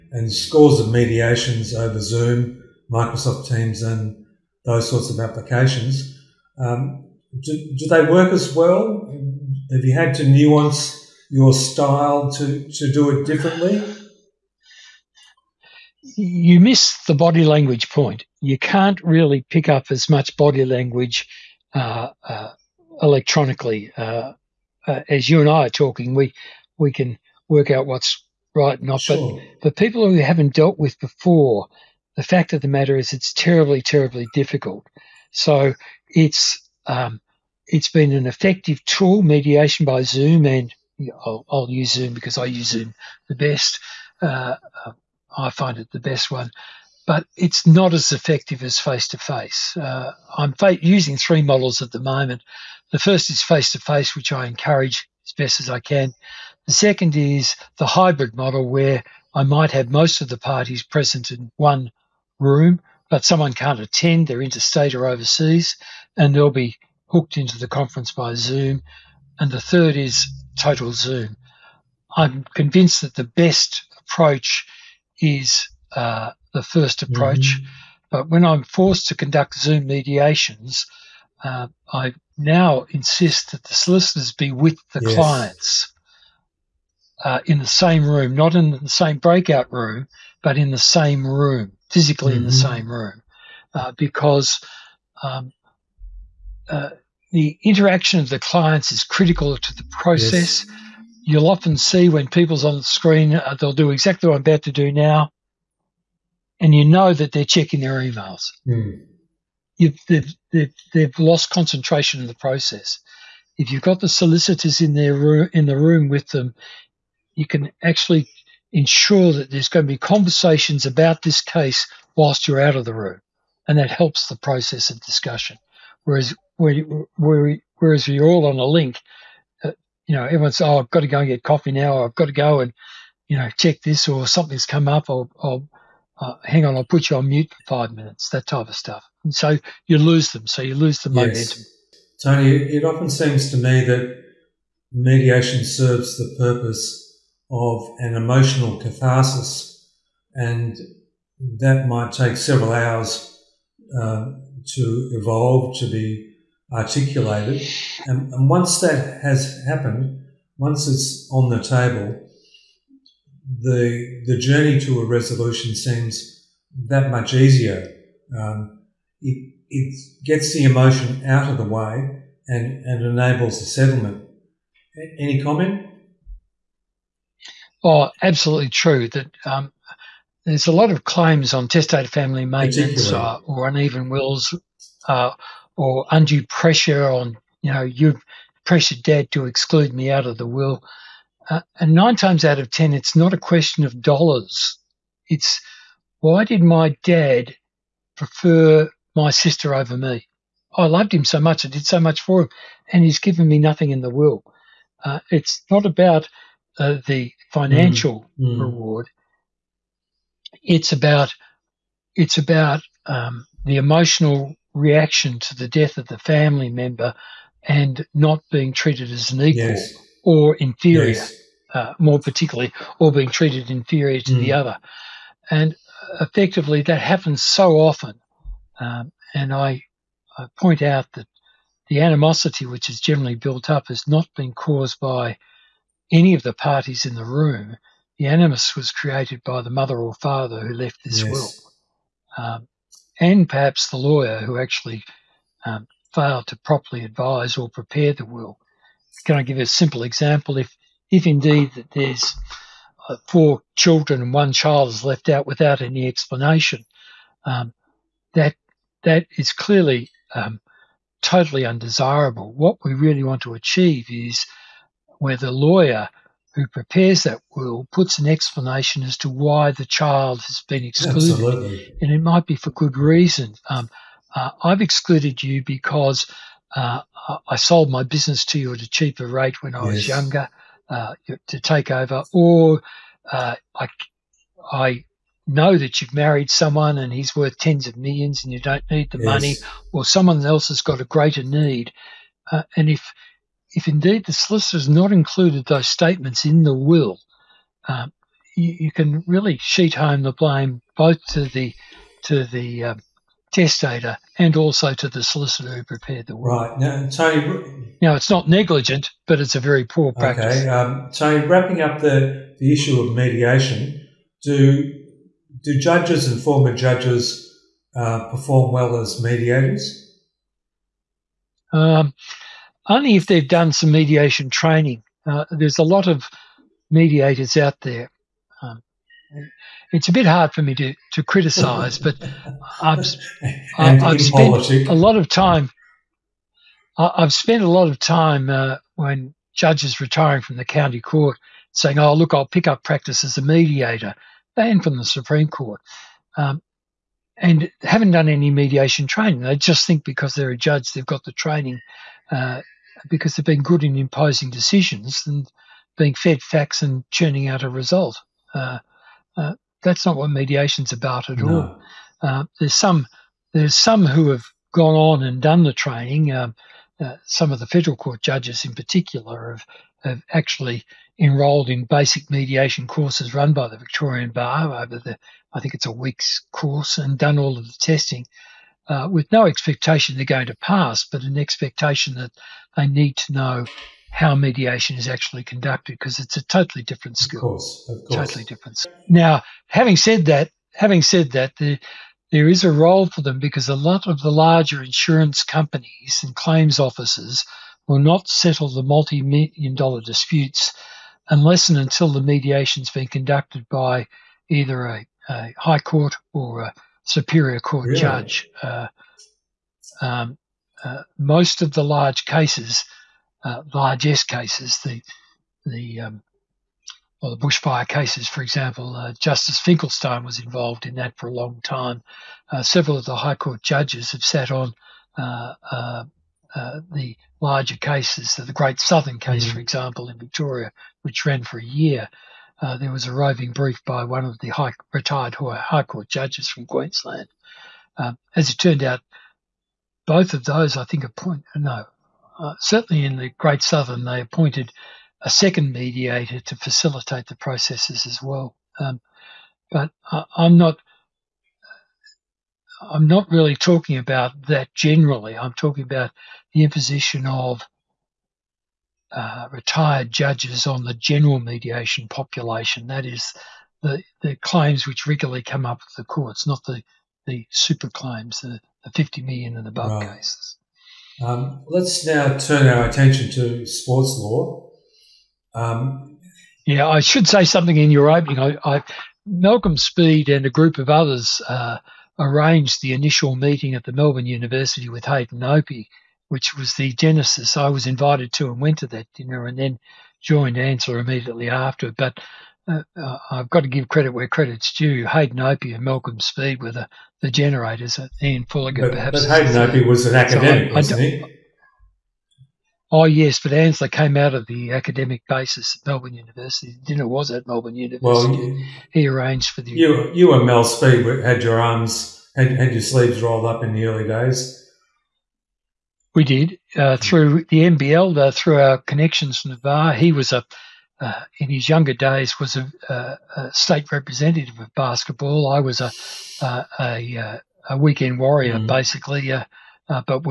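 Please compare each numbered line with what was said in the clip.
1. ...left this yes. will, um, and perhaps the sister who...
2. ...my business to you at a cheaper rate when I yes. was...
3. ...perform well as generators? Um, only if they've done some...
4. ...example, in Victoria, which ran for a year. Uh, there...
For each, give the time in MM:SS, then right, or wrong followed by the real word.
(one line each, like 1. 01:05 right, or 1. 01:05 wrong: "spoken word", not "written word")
1. 04:00 wrong: "lawyer", not "sister"
2. 04:37 right
3. 05:18 wrong: "mediators", not "generators"
4. 07:09 right.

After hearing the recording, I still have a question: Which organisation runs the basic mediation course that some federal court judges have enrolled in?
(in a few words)
The Victorian Bar.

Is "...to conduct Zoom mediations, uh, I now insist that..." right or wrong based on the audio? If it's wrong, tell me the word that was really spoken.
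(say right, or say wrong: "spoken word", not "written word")
right.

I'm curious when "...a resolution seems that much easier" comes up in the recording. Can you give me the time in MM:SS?
02:45.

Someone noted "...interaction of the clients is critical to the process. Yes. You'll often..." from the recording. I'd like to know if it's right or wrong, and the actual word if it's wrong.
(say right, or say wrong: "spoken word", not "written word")
right.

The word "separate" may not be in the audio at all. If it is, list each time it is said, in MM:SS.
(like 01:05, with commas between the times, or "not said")
not said.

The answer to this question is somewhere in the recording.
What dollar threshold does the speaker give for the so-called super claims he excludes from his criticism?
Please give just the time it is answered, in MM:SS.
07:48.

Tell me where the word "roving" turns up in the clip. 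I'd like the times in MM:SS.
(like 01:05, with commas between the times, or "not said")
07:13.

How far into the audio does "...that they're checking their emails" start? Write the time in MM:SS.
01:47.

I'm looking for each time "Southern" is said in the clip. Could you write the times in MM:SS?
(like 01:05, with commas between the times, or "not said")
07:08, 07:23.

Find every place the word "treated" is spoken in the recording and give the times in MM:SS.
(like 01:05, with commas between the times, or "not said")
03:38, 03:43.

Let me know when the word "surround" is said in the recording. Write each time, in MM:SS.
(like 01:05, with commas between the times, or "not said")
not said.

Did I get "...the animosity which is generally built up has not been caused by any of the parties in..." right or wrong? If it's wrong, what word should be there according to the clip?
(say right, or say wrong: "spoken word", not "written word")
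right.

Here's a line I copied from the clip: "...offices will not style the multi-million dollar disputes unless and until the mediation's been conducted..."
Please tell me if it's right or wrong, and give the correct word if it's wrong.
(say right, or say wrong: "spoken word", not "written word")
wrong: "settle", not "style".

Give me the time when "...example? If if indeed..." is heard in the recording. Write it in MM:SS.
04:10.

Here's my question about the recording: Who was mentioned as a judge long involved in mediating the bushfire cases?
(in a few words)
Justice Finkelstein.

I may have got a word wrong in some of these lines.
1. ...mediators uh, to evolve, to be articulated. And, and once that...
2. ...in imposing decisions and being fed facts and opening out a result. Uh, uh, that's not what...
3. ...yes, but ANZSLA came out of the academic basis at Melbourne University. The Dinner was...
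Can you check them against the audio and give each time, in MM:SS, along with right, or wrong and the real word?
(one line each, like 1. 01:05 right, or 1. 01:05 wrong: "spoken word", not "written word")
1. 02:32 wrong: "hours", not "mediators"
2. 05:53 wrong: "churning", not "opening"
3. 08:23 right.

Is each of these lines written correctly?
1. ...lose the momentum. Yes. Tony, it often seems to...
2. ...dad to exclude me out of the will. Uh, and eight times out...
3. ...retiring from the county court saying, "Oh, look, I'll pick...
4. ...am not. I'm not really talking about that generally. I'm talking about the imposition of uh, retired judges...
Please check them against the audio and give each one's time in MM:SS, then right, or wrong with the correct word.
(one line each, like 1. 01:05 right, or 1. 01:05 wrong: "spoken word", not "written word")
1. 02:20 right
2. 03:09 wrong: "nine", not "eight"
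3. 05:40 right
4. 07:30 right.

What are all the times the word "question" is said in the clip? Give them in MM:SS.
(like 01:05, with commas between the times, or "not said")
03:13.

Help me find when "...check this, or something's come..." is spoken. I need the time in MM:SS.
02:13.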